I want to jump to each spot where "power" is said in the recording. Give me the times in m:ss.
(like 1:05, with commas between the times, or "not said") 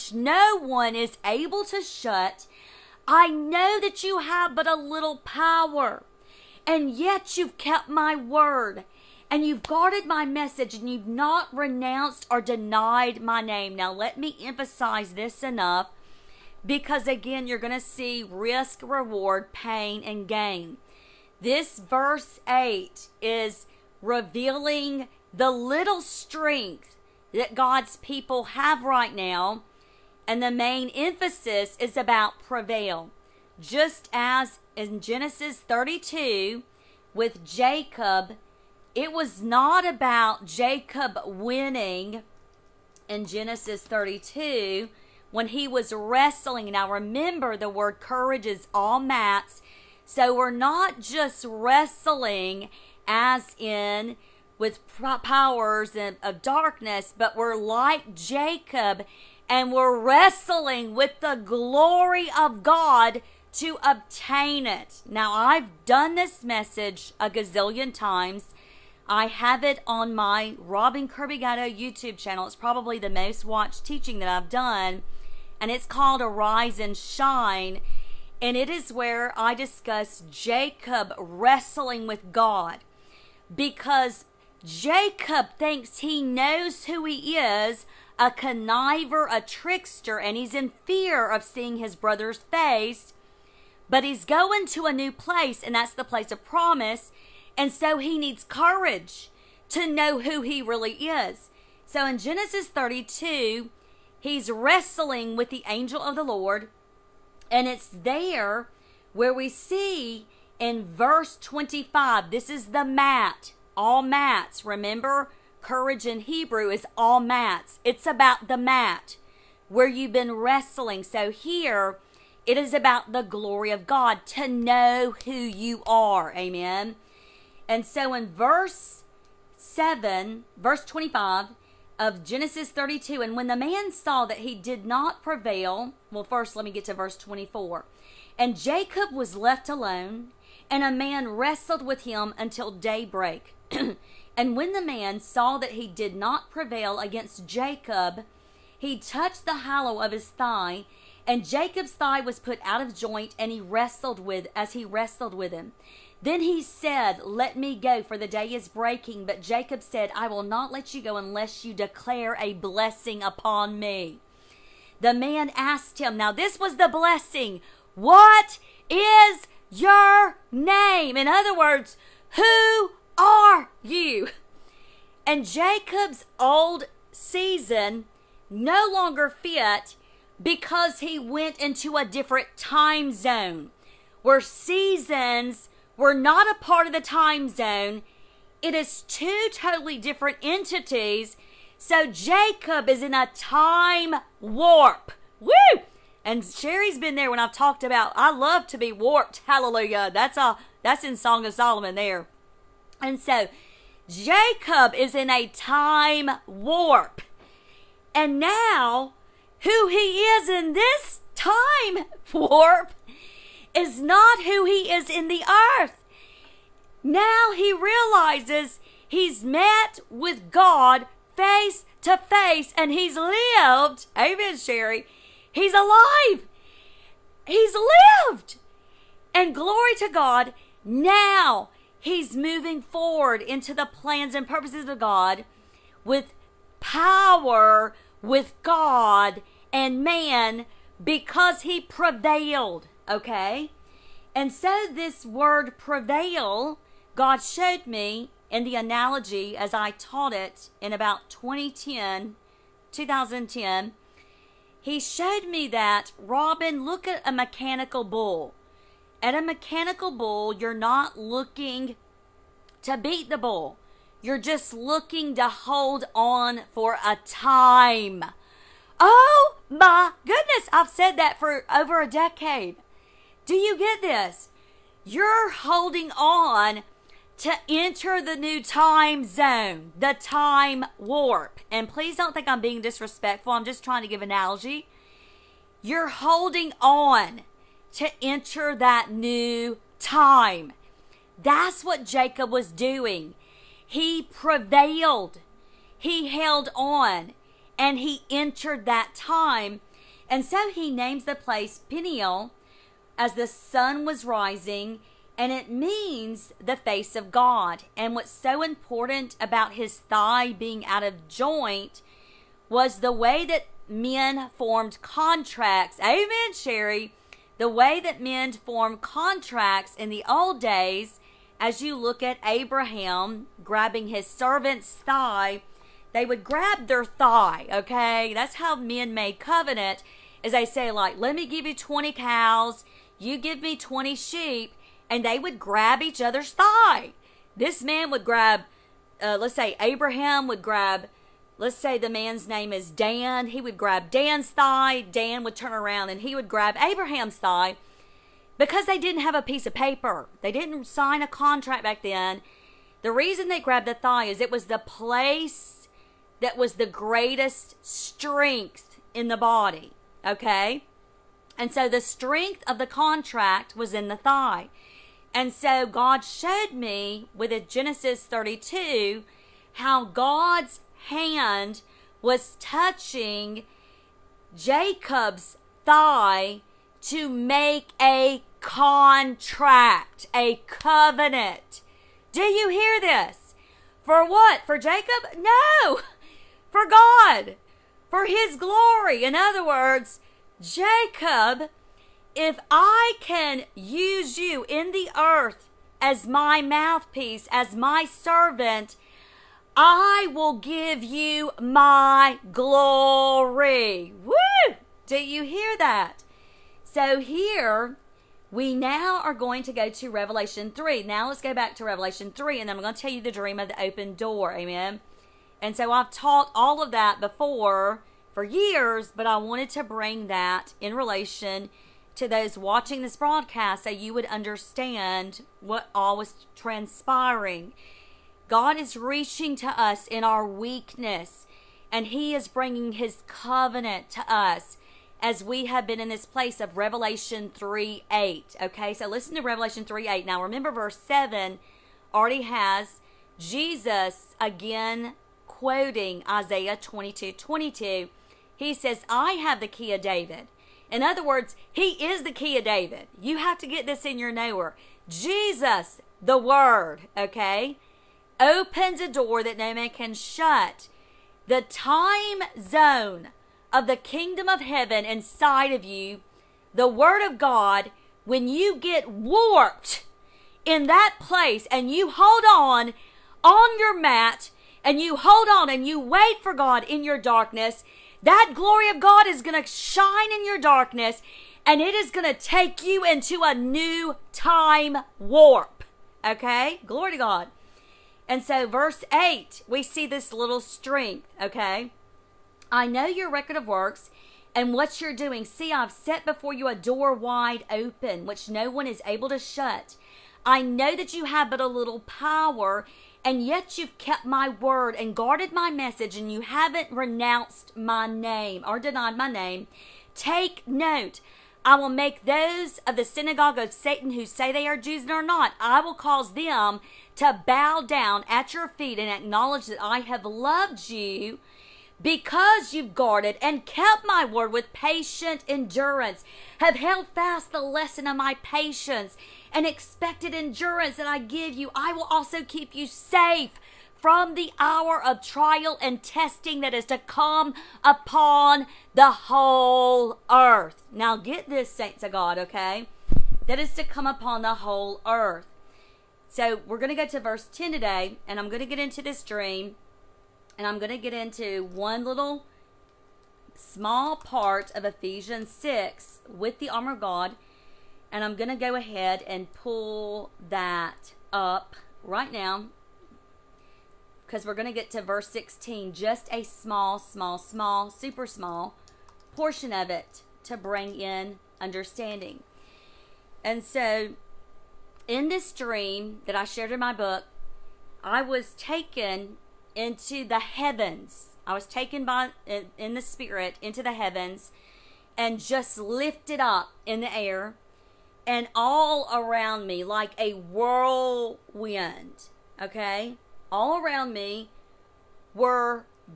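0:05, 0:55, 3:56, 8:21.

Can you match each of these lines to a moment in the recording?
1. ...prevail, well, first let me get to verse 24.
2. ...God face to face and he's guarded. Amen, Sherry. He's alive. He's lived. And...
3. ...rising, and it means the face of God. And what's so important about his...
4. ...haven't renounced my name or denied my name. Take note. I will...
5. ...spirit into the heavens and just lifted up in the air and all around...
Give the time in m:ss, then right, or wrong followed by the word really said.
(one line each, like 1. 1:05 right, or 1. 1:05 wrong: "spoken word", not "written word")
1. 2:15 right
2. 3:40 wrong: "lived", not "guarded"
3. 5:04 right
4. 8:26 right
5. 9:43 right.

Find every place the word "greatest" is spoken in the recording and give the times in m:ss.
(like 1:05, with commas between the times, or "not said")
5:56.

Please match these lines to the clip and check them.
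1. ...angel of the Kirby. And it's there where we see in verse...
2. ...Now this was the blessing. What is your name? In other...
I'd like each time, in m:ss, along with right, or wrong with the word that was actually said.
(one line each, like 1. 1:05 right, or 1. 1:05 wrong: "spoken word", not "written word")
1. 1:45 wrong: "Lord", not "Kirby"
2. 2:46 right.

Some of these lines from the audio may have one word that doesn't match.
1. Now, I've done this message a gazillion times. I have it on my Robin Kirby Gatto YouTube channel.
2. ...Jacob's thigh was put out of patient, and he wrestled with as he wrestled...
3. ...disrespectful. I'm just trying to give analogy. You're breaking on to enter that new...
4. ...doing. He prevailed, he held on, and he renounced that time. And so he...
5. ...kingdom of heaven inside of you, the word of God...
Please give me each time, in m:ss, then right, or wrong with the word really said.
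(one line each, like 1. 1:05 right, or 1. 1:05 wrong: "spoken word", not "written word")
1. 1:05 right
2. 2:31 wrong: "joint", not "patient"
3. 4:42 wrong: "holding", not "breaking"
4. 4:52 wrong: "entered", not "renounced"
5. 7:43 right.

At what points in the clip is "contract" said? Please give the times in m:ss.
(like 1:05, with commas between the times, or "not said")
5:15, 5:19, 5:51, 6:02, 6:18.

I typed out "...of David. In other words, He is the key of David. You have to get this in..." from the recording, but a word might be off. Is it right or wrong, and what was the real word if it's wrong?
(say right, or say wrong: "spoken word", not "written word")
right.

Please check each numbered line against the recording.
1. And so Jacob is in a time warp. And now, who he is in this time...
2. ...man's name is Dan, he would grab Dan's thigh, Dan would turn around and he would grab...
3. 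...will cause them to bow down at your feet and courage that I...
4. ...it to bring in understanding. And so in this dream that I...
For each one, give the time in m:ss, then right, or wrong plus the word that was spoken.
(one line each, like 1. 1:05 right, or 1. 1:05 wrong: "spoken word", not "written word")
1. 3:23 right
2. 5:42 right
3. 8:35 wrong: "acknowledge", not "courage"
4. 9:29 right.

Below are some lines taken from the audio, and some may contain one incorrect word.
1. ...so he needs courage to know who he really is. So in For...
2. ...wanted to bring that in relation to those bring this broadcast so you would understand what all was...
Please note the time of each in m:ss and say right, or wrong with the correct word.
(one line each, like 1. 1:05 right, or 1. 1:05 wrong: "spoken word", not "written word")
1. 1:37 wrong: "Genesis", not "For"
2. 6:59 wrong: "watching", not "bring".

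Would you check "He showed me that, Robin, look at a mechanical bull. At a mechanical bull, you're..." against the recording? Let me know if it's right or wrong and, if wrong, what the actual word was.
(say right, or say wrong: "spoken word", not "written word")
right.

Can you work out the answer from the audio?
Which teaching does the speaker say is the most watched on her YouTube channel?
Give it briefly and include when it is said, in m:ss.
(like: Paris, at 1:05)
Arise and Shine, at 1:16.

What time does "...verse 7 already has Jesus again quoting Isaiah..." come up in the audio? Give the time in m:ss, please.
7:20.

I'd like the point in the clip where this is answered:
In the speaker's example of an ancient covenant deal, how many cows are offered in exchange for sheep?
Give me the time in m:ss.
5:31.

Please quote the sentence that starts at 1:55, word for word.
courage in Hebrew is all mats.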